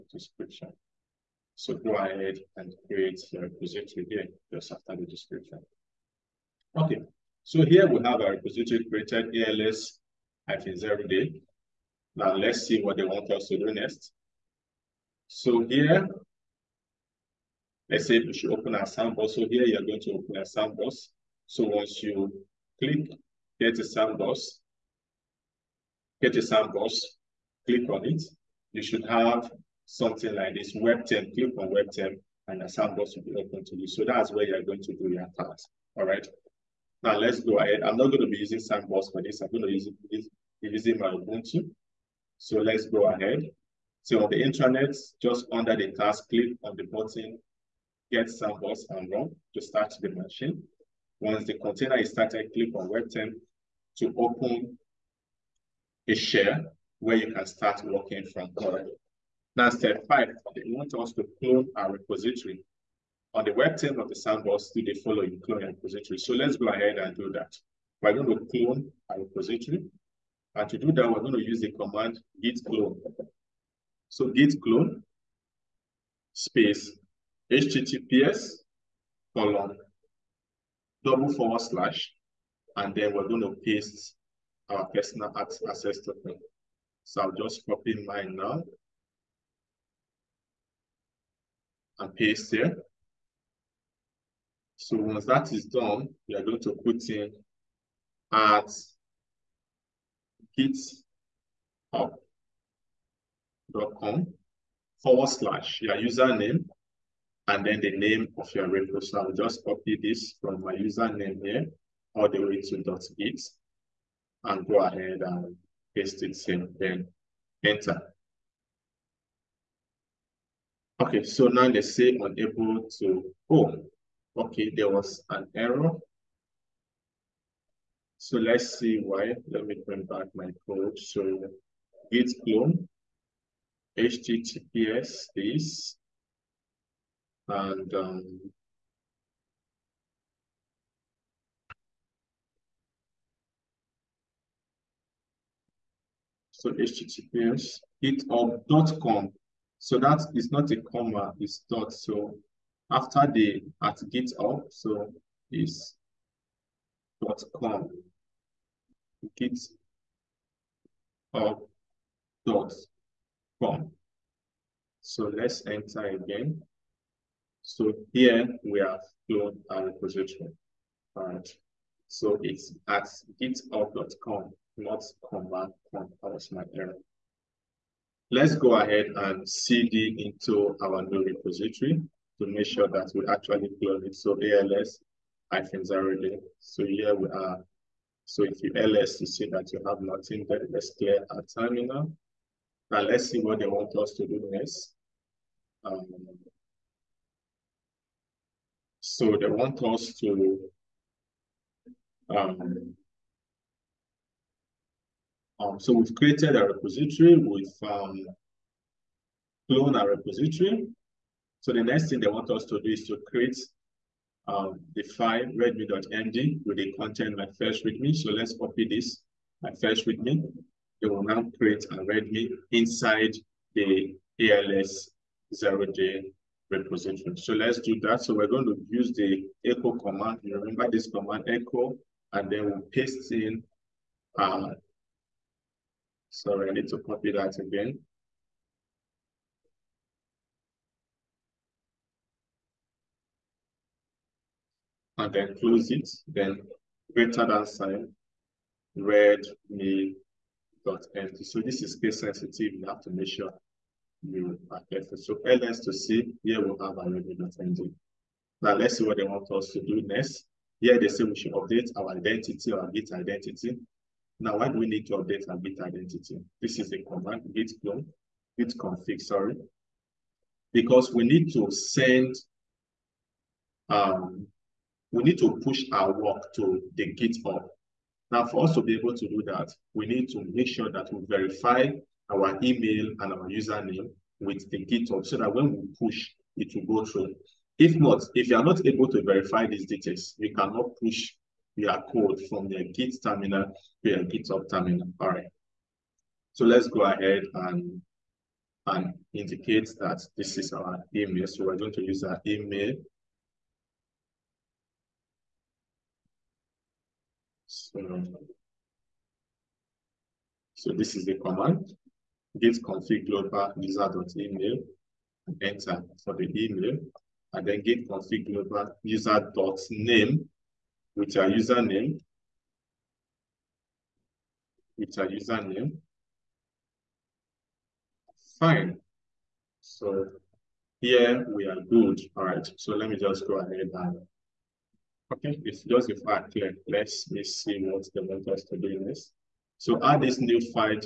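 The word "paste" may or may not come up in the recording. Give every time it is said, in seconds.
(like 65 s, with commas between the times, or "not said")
83 s, 92 s, 115 s, 232 s.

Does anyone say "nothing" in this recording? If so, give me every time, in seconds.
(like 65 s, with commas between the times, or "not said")
190 s.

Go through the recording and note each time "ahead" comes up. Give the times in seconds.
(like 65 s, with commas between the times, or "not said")
1 s, 37 s, 43 s, 66 s, 114 s, 178 s, 297 s, 333 s.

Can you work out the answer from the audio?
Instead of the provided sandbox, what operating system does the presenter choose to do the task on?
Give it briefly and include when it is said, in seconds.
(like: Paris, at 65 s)
Ubuntu, at 41 s.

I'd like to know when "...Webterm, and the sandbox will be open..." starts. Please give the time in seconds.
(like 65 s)
31 s.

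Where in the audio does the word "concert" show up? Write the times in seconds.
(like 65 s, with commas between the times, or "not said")
not said.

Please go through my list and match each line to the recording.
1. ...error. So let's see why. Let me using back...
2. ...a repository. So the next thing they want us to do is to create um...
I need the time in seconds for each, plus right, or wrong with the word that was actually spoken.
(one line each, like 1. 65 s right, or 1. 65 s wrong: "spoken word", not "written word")
1. 125 s wrong: "bring", not "using"
2. 210 s right.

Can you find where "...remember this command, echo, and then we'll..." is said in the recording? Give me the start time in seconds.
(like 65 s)
230 s.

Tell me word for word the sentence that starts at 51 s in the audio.
Once the container is started, click on Web Webterm to open a share where you can start working from currently.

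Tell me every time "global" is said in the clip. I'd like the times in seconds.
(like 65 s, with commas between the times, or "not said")
313 s, 318 s.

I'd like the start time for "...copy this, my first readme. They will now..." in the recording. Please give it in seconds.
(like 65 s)
218 s.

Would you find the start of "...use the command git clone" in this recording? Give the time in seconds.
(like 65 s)
71 s.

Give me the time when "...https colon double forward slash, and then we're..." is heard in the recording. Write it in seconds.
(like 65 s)
77 s.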